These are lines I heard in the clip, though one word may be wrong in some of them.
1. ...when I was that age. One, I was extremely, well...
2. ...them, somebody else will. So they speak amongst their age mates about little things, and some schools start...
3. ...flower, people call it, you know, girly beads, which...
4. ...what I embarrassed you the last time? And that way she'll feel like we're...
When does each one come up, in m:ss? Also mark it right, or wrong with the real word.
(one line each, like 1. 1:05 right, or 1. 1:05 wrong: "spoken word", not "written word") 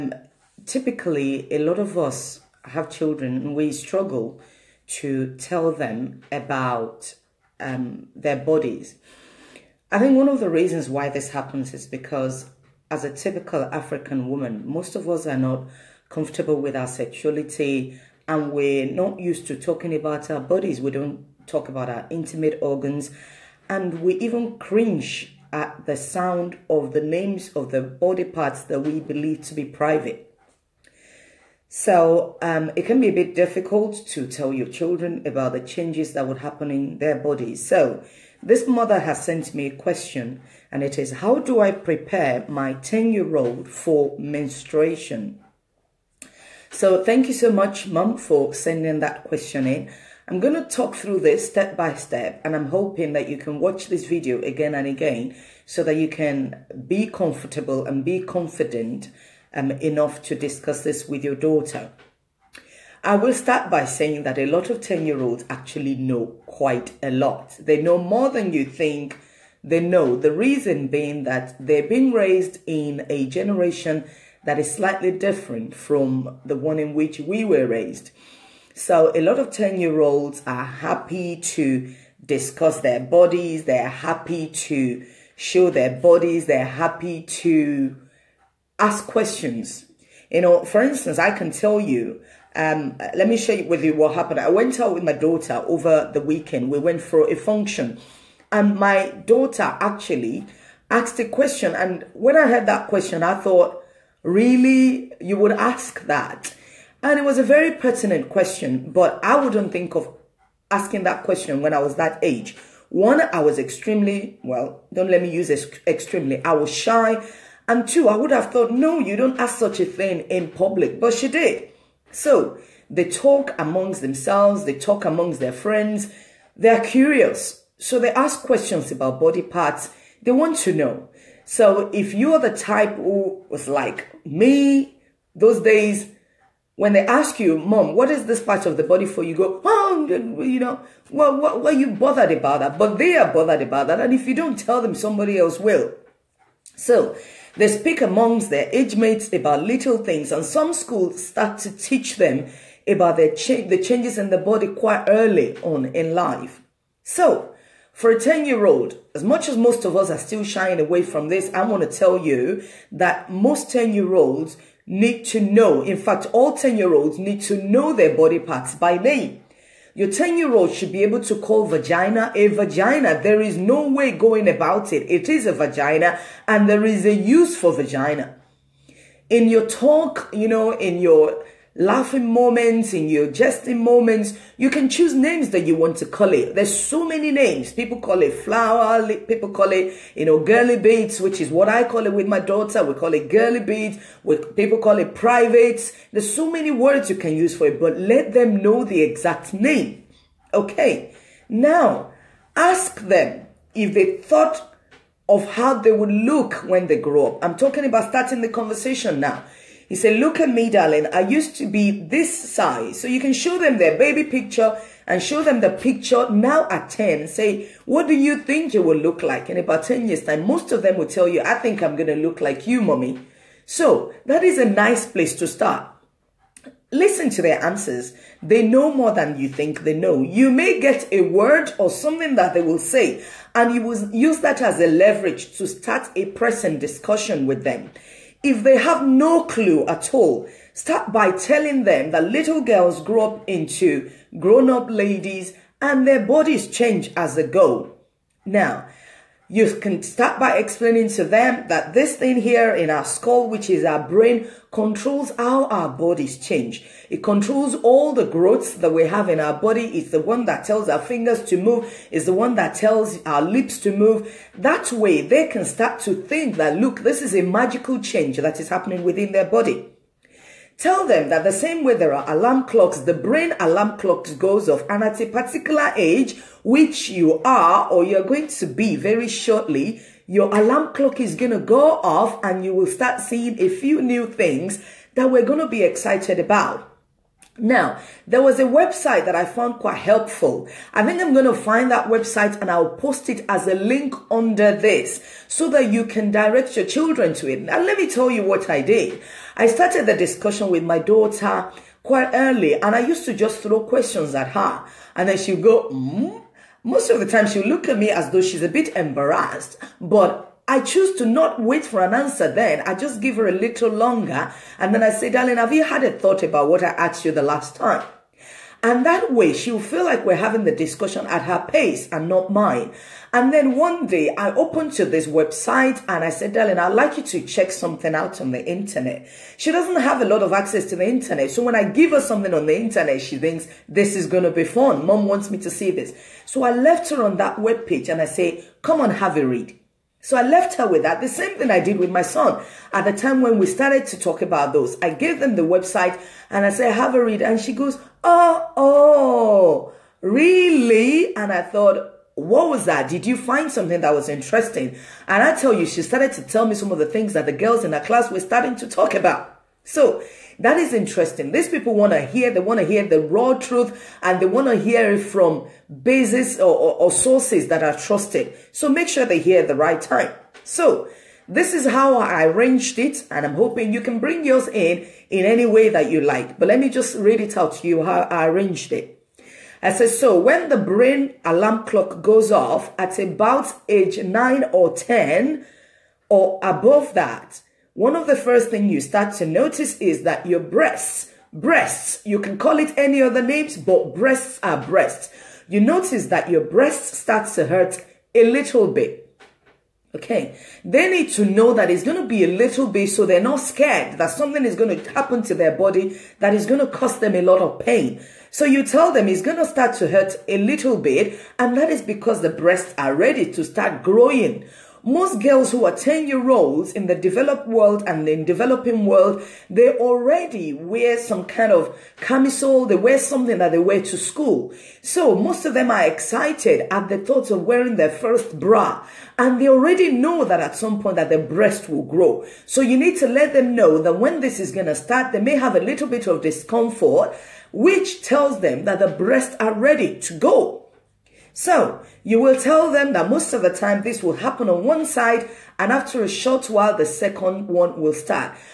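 1. 1:51 right
2. 2:24 right
3. 3:08 right
4. 5:16 wrong: "asked", not "embarrassed".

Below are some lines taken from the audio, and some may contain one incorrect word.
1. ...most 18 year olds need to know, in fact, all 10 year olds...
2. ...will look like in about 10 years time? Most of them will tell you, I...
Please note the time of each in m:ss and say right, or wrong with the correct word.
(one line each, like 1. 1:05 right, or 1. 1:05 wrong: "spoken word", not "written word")
1. 2:43 wrong: "10", not "18"
2. 3:38 right.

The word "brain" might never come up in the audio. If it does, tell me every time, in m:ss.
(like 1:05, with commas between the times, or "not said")
4:14, 4:33, 6:20.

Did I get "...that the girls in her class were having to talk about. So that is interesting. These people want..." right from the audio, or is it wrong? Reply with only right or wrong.
wrong.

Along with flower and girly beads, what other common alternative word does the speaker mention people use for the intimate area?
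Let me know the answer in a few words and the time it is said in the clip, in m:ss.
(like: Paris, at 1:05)
privates, at 3:15.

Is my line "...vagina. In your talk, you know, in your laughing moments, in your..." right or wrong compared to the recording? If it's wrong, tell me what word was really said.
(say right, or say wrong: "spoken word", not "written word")
right.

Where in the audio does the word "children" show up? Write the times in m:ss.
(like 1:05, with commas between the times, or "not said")
0:02, 0:34, 4:56.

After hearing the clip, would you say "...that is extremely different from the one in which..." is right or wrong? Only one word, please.
wrong.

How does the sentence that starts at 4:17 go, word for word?
It controls all the growths that we have in our body.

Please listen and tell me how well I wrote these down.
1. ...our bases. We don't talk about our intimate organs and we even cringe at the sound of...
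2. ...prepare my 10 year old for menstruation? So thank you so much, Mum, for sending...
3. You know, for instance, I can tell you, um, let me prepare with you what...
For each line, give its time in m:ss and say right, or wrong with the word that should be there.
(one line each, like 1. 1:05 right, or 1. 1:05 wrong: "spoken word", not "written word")
1. 0:20 wrong: "bodies", not "bases"
2. 0:41 right
3. 1:30 wrong: "share", not "prepare".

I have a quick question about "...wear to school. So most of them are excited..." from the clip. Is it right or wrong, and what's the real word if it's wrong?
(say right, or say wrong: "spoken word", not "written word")
right.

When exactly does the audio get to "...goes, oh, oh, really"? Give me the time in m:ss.
5:47.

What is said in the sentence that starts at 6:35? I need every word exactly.
You notice that your breasts start to hurt a little bit.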